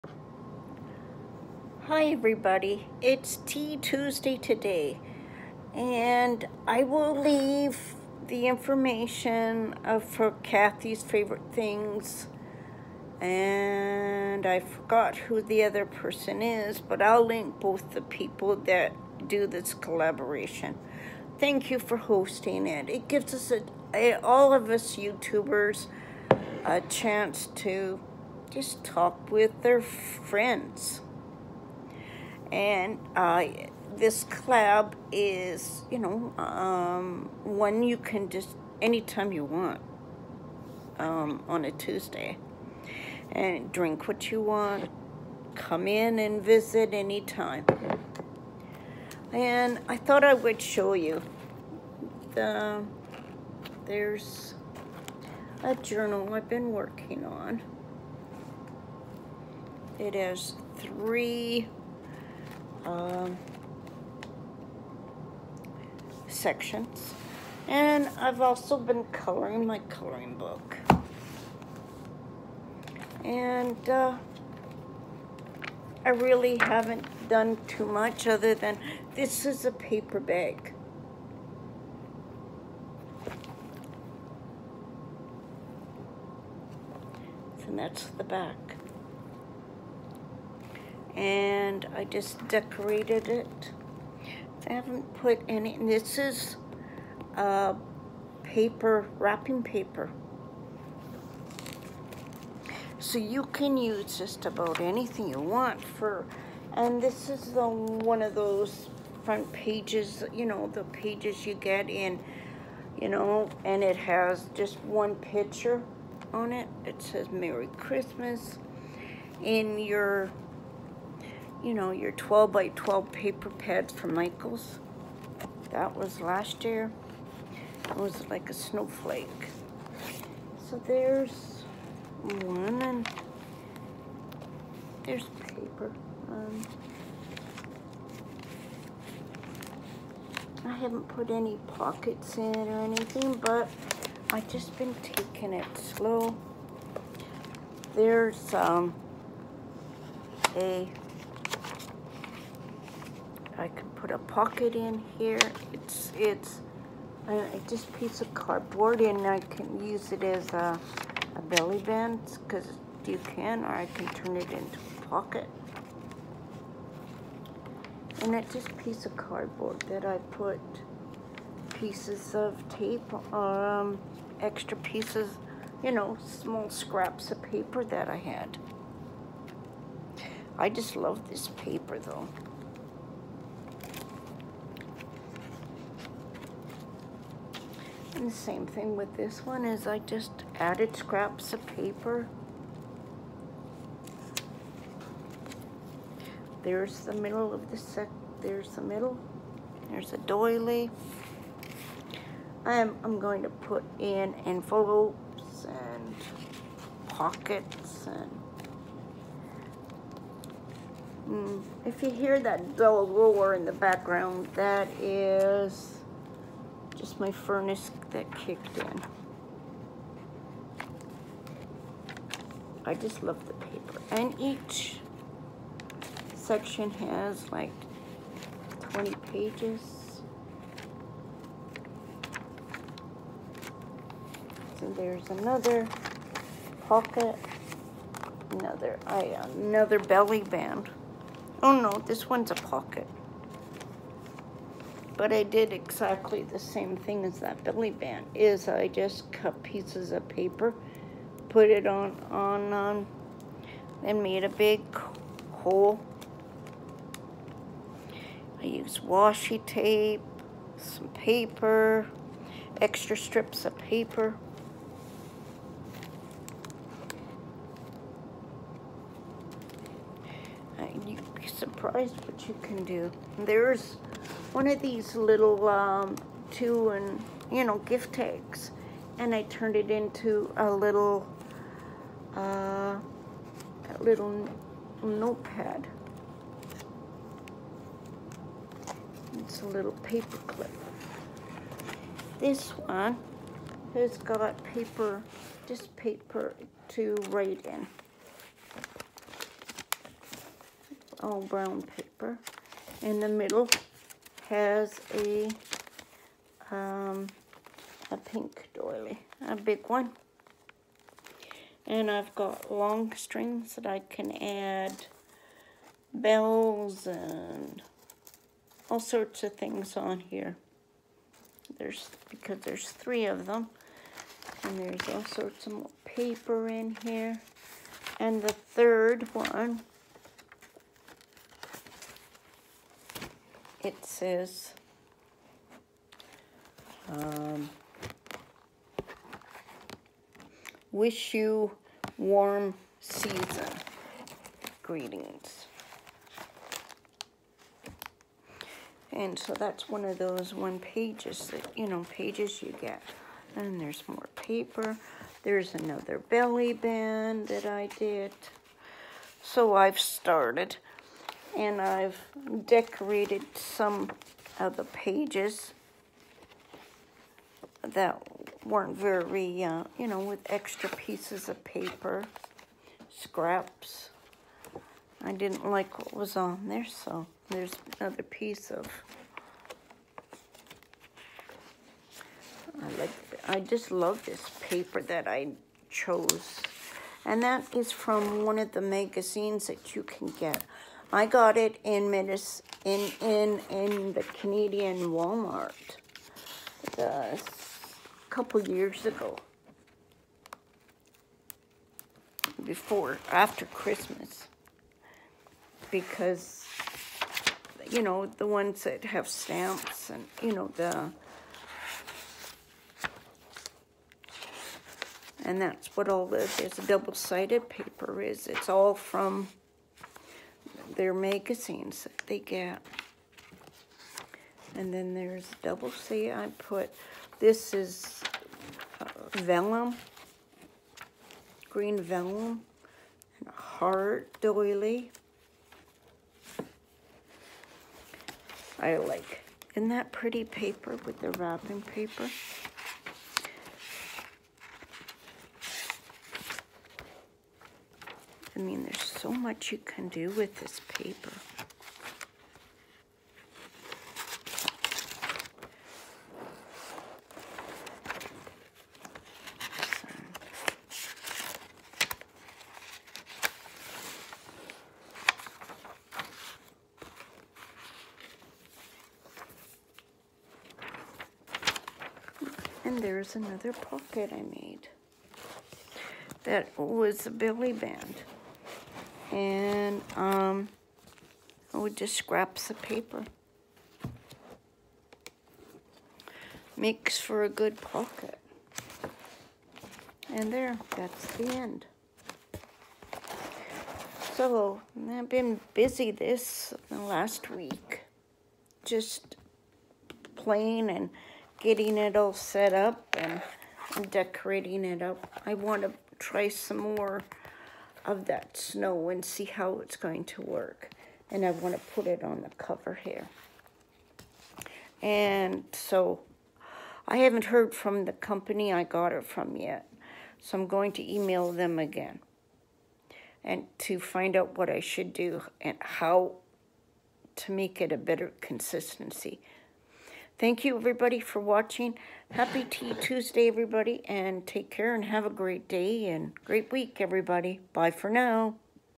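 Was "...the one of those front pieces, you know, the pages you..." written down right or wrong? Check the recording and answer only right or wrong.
wrong.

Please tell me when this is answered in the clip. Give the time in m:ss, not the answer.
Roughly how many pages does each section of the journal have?
3:48.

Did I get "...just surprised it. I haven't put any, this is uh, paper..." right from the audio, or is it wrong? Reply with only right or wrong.
wrong.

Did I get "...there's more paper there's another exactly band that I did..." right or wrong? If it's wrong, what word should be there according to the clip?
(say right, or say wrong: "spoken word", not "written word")
wrong: "belly", not "exactly".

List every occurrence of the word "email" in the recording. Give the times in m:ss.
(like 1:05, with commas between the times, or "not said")
8:41.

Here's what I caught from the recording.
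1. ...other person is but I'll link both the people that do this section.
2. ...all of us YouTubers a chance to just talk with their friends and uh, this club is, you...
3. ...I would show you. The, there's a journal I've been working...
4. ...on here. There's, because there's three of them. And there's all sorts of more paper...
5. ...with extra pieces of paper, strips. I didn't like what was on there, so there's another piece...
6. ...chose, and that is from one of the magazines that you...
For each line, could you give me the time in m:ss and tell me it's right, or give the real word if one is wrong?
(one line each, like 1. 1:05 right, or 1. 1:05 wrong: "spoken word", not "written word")
1. 0:15 wrong: "collaboration", not "section"
2. 0:24 right
3. 0:50 right
4. 5:19 right
5. 6:10 wrong: "scraps", not "strips"
6. 6:25 right.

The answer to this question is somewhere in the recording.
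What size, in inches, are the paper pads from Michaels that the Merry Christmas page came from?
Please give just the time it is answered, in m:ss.
2:02.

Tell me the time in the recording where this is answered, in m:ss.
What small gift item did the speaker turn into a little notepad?
4:37.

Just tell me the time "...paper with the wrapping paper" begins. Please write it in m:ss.
7:20.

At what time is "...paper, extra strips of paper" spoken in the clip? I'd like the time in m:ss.
4:21.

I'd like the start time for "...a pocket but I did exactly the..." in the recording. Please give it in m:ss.
4:02.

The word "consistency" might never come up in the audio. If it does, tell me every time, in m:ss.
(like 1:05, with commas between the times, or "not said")
8:48.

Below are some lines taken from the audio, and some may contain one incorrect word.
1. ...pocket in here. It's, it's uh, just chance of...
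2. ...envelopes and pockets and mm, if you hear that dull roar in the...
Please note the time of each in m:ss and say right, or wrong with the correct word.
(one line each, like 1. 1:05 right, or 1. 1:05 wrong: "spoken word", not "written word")
1. 2:34 wrong: "piece", not "chance"
2. 3:24 right.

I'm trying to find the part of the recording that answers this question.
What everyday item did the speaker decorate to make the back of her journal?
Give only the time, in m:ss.
1:19.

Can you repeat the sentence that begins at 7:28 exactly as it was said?
I mean, there's so much you can do with this paper.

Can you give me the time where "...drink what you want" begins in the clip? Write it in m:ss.
0:43.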